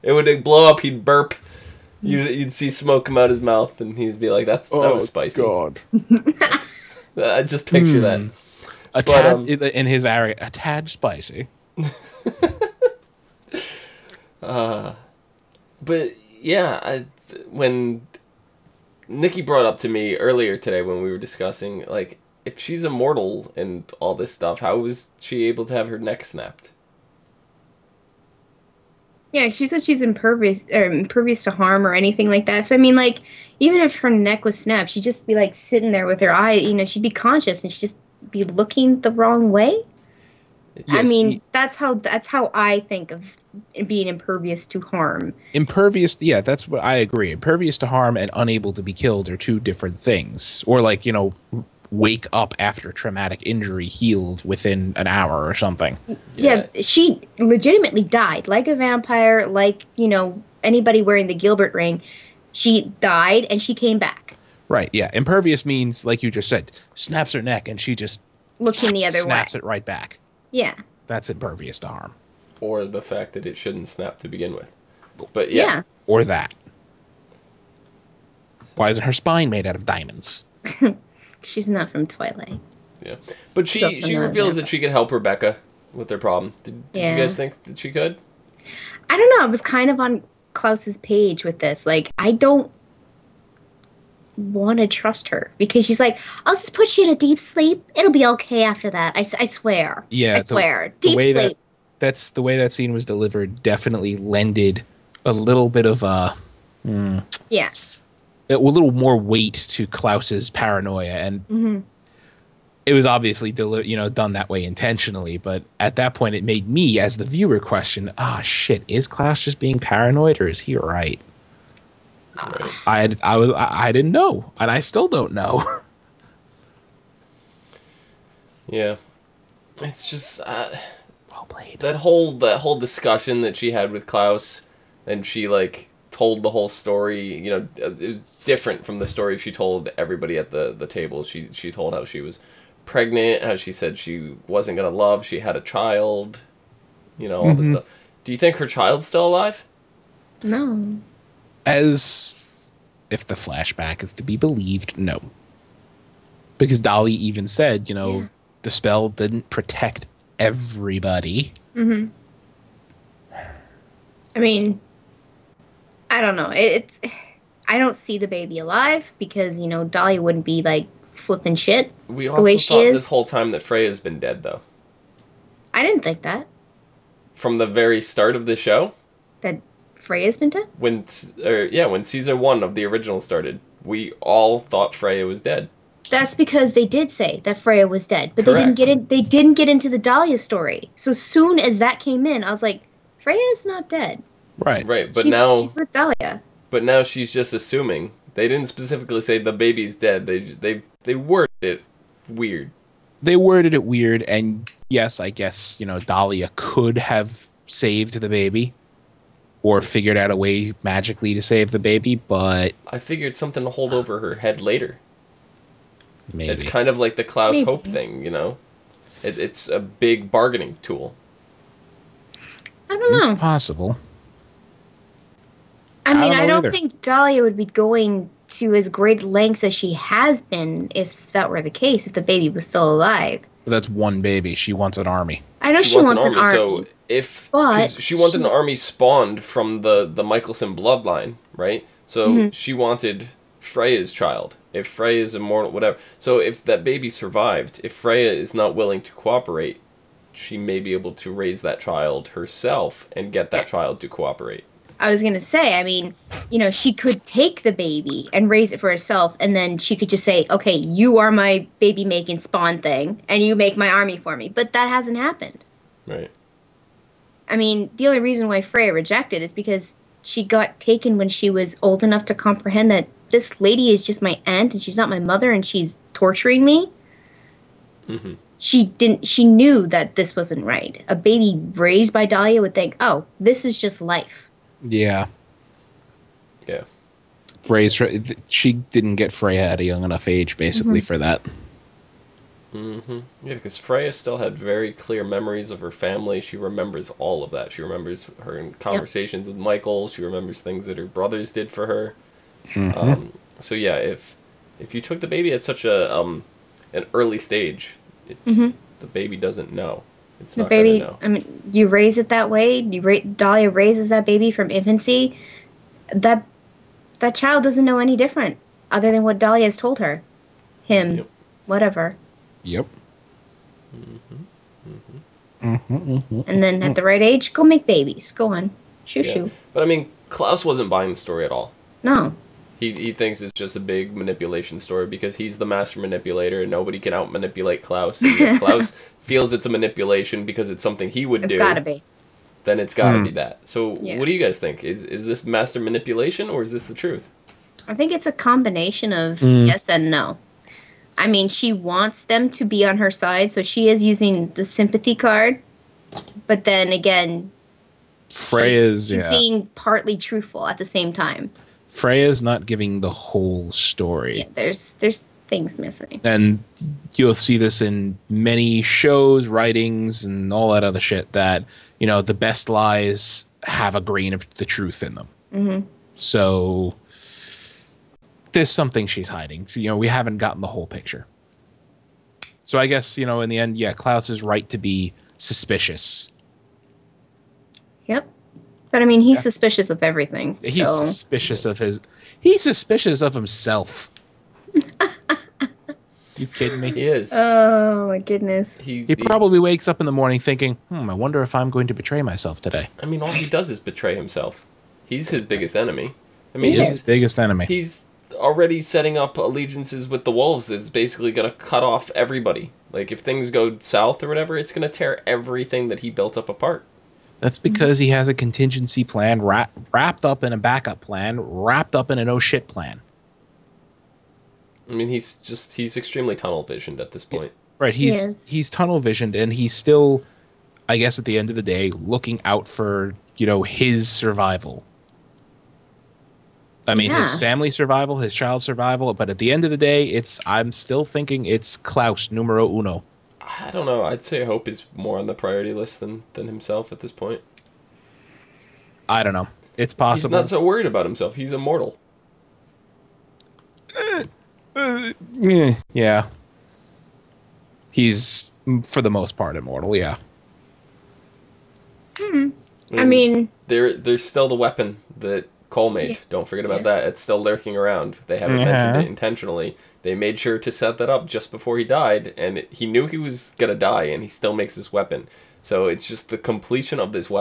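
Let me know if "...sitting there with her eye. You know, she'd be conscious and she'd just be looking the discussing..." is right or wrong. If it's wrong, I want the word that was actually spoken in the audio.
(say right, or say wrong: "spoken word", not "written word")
wrong: "wrong", not "discussing".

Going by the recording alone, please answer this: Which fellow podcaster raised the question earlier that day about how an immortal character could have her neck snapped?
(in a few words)
Nikki.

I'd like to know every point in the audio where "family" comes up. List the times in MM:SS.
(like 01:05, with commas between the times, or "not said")
04:55, 07:17.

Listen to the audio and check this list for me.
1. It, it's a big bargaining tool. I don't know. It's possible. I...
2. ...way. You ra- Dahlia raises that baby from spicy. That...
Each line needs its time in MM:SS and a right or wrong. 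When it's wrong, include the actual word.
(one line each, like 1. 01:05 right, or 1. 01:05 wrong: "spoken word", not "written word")
1. 03:39 right
2. 05:12 wrong: "infancy", not "spicy".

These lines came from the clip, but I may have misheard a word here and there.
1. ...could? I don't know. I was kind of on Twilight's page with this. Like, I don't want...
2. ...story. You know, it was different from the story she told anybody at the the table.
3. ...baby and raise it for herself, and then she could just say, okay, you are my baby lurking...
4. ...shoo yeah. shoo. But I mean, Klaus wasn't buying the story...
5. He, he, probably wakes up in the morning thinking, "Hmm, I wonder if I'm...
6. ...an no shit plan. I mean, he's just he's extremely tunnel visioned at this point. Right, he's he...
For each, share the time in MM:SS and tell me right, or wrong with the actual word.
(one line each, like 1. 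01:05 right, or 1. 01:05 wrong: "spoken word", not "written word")
1. 01:27 wrong: "Klaus", not "Twilight"
2. 02:16 wrong: "everybody", not "anybody"
3. 04:17 wrong: "making", not "lurking"
4. 05:29 right
5. 06:38 right
6. 07:02 right.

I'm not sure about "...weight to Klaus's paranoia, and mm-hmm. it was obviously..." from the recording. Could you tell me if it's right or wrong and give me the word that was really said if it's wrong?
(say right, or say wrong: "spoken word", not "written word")
right.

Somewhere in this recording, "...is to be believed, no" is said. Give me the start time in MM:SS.
02:34.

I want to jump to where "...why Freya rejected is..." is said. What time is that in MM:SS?
04:28.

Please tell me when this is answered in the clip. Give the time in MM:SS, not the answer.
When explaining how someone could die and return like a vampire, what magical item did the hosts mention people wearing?
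01:01.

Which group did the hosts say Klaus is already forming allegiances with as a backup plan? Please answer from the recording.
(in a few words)
the wolves.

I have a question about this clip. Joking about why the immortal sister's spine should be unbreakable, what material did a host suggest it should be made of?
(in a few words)
diamonds.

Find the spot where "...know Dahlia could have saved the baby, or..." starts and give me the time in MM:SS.
03:25.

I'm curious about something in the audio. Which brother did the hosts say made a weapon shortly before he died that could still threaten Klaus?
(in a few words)
Kol.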